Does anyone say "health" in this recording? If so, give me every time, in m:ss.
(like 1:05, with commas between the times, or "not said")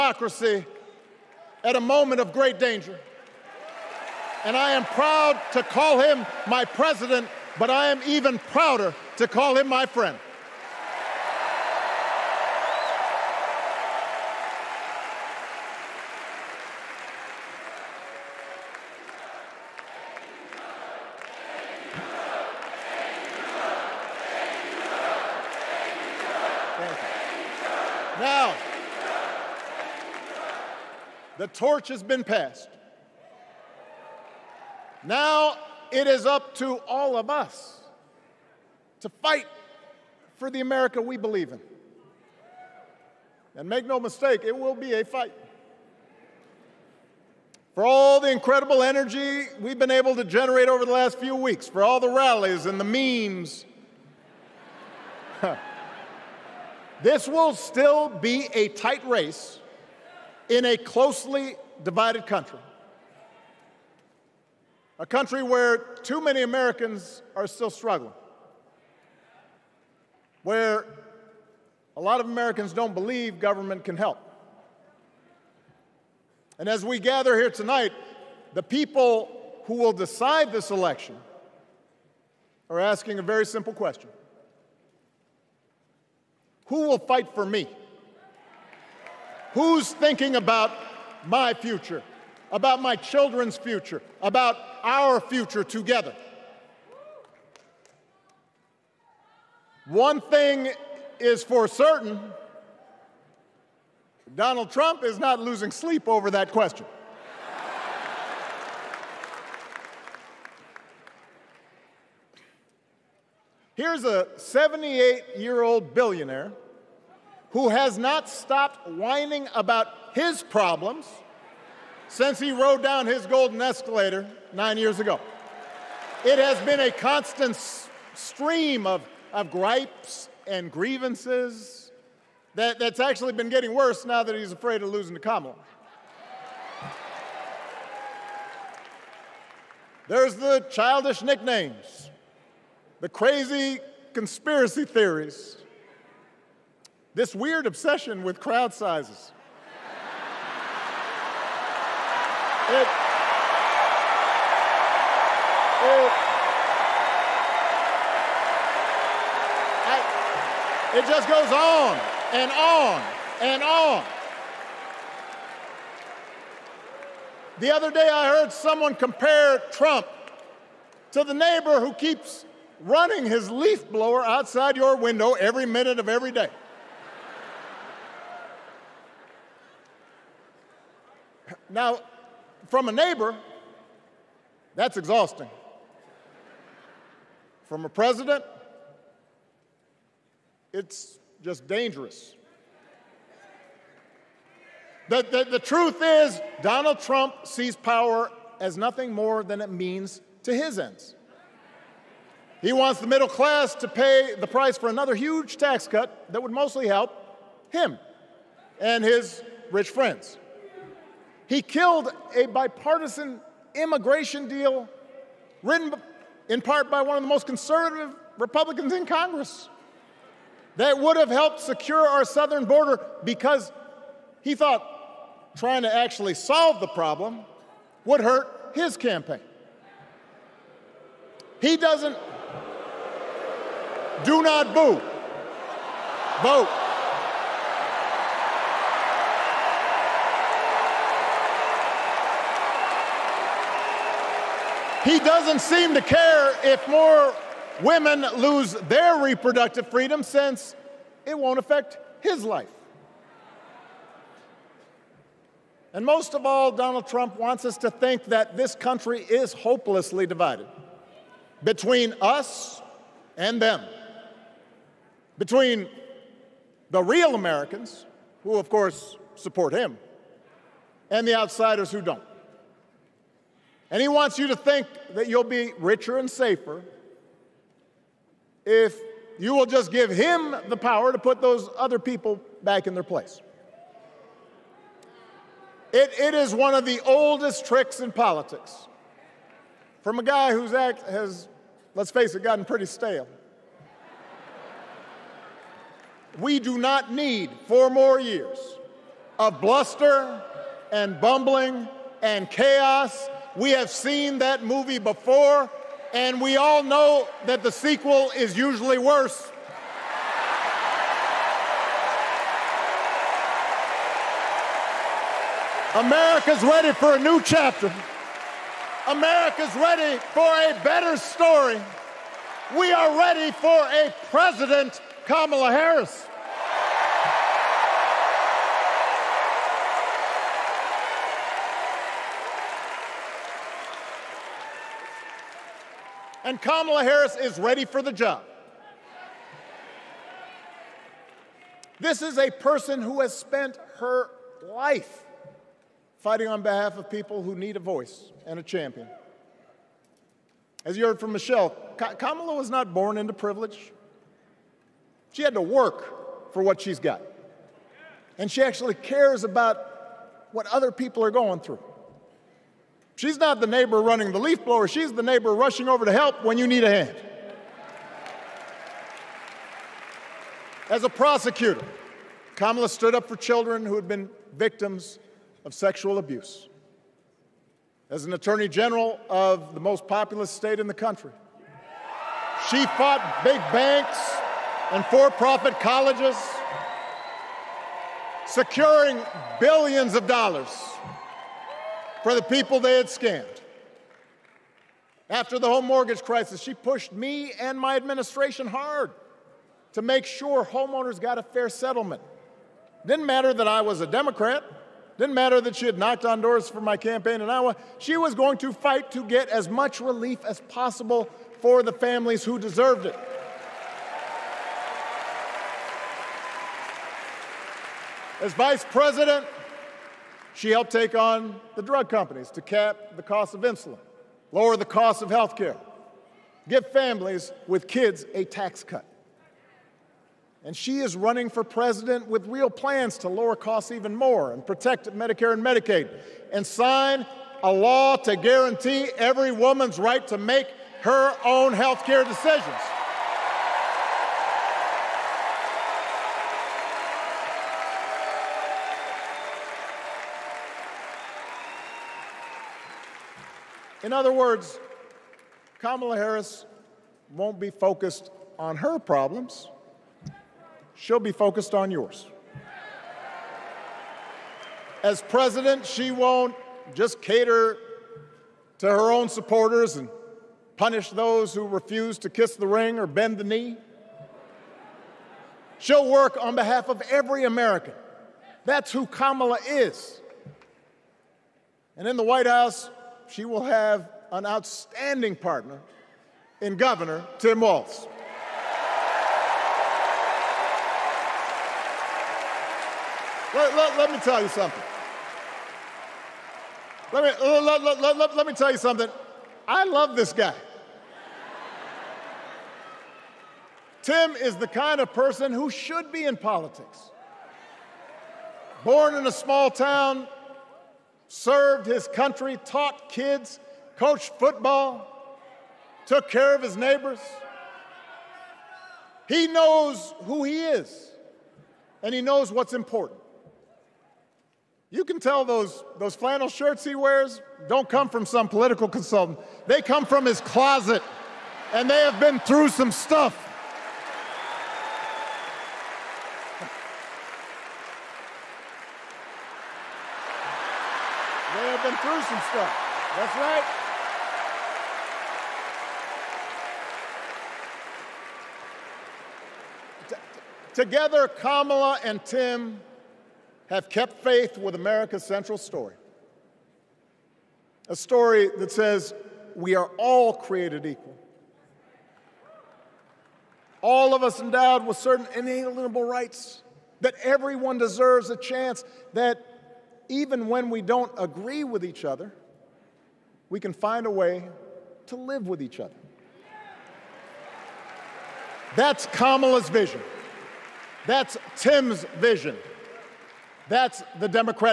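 7:05, 7:21.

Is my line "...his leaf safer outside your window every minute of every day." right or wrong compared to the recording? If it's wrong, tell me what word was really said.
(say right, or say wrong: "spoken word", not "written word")
wrong: "blower", not "safer".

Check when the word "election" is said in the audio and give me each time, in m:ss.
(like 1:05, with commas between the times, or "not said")
1:20.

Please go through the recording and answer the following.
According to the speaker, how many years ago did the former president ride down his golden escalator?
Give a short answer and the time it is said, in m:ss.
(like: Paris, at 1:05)
9, at 2:04.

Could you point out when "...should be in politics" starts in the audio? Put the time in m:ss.
8:25.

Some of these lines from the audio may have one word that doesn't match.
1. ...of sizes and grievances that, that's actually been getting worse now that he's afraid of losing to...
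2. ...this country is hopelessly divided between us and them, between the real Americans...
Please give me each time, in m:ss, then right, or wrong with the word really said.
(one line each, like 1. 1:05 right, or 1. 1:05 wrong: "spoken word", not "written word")
1. 2:09 wrong: "gripes", not "sizes"
2. 4:18 right.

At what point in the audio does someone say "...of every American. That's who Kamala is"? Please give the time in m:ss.
7:56.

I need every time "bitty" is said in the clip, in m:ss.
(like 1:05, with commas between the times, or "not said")
not said.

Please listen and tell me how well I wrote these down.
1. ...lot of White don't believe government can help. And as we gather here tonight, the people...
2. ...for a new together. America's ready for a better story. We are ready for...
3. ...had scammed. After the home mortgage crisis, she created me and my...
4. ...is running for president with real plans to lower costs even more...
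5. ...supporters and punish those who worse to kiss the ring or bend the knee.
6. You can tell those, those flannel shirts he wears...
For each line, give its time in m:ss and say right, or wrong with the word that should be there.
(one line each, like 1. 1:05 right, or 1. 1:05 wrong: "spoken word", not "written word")
1. 1:12 wrong: "Americans", not "White"
2. 5:16 wrong: "chapter", not "together"
3. 6:32 wrong: "pushed", not "created"
4. 7:10 right
5. 7:49 wrong: "refuse", not "worse"
6. 8:44 right.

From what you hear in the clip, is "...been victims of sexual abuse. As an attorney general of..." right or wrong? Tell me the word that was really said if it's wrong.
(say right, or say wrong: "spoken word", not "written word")
right.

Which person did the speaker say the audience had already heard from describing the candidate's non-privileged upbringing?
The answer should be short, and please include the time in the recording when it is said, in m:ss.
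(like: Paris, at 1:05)
Michelle, at 5:51.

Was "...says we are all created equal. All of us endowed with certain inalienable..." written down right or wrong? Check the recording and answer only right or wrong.
right.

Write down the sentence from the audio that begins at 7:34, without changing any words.
In other words, Kamala Harris won't be focused on her problems, she'll be focused on yours.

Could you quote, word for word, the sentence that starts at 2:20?
There's the childish nicknames, the crazy conspiracy theories this weird obsession with crowd sizes.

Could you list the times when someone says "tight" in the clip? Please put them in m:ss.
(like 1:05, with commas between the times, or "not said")
0:58.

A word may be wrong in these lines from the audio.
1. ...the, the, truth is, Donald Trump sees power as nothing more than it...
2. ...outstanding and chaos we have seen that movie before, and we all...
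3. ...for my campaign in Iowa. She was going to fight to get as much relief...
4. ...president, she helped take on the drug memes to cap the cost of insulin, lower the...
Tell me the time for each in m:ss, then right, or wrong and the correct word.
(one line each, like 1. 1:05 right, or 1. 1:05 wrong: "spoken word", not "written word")
1. 3:15 right
2. 5:01 wrong: "bumbling", not "outstanding"
3. 6:46 right
4. 6:58 wrong: "companies", not "memes".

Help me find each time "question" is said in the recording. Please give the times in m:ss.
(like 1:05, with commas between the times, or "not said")
1:23, 1:46.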